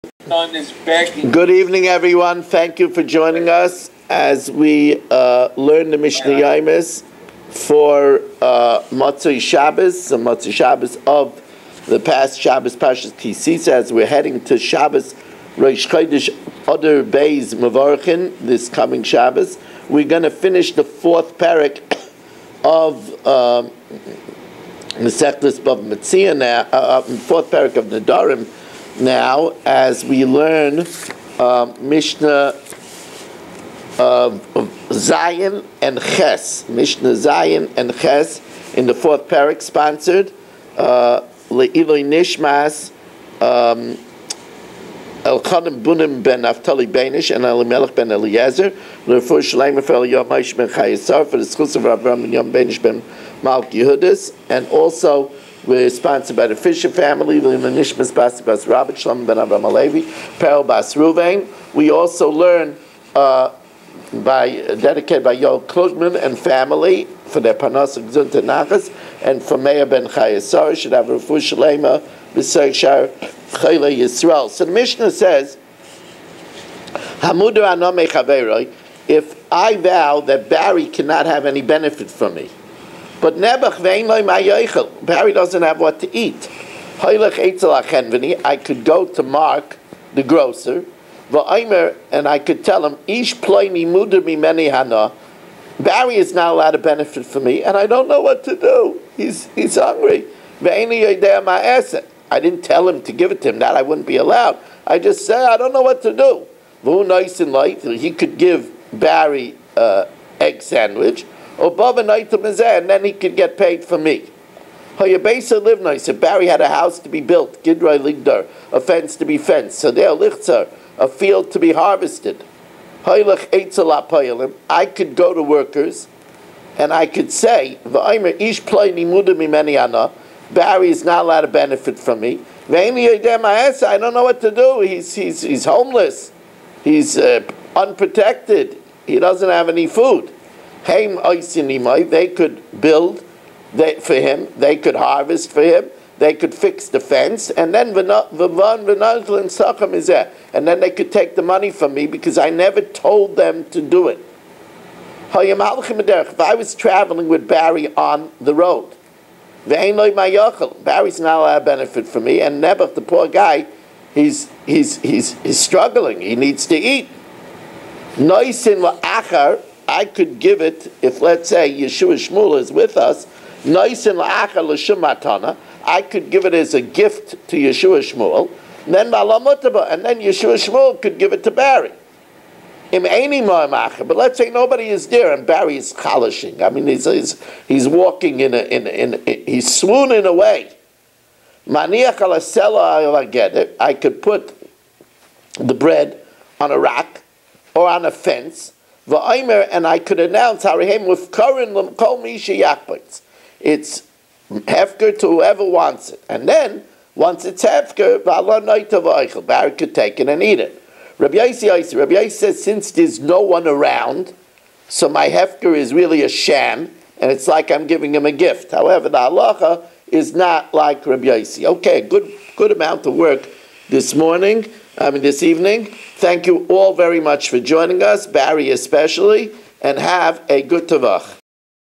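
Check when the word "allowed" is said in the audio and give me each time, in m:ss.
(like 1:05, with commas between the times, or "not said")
1:36, 1:44, 2:11, 2:41.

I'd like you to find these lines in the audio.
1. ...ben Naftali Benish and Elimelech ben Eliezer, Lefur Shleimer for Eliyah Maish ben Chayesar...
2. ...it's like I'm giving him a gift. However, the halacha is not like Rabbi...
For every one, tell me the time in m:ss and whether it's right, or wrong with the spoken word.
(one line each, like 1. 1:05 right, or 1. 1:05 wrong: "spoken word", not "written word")
1. 0:46 right
2. 3:37 right.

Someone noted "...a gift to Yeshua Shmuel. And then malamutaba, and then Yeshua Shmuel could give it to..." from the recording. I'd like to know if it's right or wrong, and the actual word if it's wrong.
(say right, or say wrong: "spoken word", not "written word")
right.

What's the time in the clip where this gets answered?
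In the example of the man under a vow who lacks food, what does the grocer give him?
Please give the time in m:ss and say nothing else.
1:50.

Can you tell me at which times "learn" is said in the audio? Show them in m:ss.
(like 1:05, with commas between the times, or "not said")
0:05, 0:30, 1:02.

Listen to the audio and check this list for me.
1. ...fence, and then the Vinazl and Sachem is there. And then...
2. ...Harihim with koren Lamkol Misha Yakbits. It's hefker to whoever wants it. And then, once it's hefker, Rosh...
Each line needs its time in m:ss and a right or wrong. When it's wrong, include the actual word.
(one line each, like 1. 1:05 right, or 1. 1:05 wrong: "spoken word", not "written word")
1. 2:26 right
2. 3:20 wrong: "Barak", not "Rosh".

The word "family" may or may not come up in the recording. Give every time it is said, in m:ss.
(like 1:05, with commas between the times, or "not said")
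0:56, 1:06.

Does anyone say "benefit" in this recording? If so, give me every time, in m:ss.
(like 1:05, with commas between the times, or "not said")
1:21, 1:36, 2:11, 2:41.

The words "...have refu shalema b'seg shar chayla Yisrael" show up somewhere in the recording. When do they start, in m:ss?
1:10.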